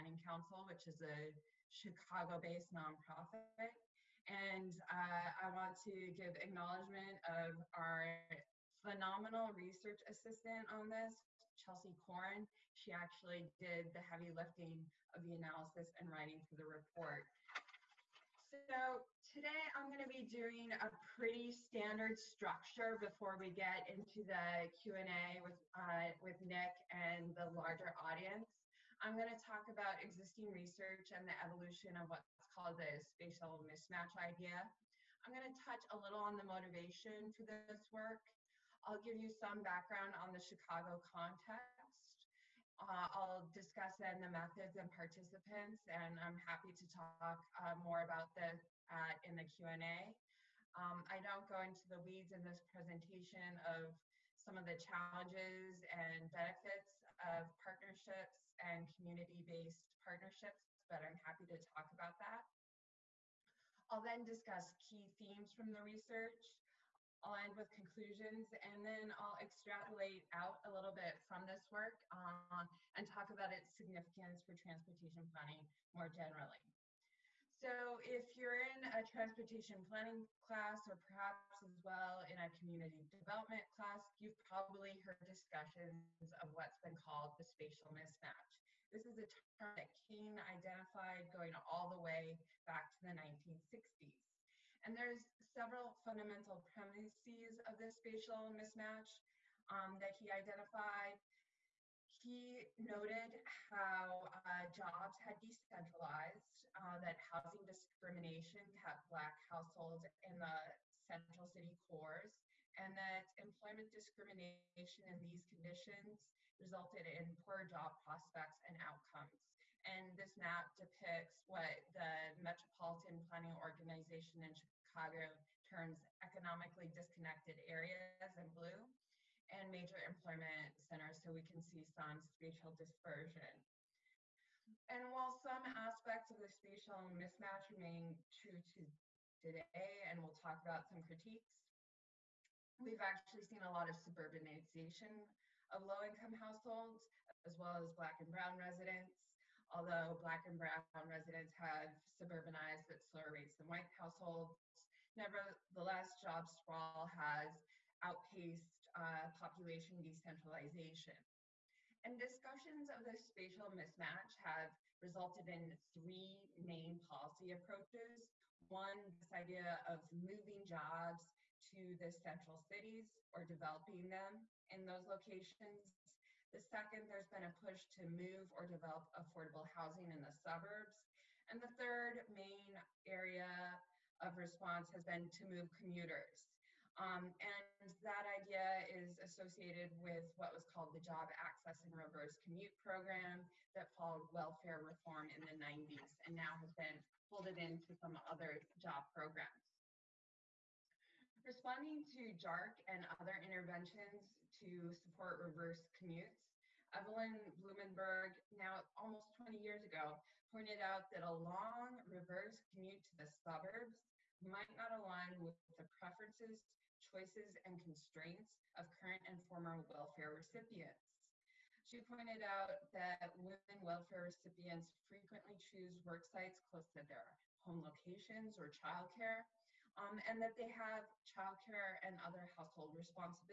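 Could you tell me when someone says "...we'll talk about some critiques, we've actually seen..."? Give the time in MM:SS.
02:20.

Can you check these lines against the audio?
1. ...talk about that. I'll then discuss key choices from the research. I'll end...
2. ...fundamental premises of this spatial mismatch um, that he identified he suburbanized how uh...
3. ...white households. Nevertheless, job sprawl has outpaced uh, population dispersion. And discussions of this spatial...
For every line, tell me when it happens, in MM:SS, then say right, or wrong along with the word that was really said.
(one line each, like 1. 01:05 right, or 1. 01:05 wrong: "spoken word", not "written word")
1. 01:01 wrong: "themes", not "choices"
2. 01:36 wrong: "noted", not "suburbanized"
3. 02:33 wrong: "decentralization", not "dispersion".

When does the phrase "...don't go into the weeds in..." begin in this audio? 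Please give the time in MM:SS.
00:51.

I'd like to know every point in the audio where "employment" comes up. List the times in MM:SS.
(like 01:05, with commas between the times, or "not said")
01:53, 02:09.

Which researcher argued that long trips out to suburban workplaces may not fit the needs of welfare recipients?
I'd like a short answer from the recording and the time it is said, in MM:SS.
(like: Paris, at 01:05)
Evelyn Blumenberg, at 03:26.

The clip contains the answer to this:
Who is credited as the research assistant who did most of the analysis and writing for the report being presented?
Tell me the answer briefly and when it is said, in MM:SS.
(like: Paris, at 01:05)
Chelsea Corn, at 00:11.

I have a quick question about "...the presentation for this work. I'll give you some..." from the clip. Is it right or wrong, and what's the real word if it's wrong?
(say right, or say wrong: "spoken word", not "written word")
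wrong: "motivation", not "presentation".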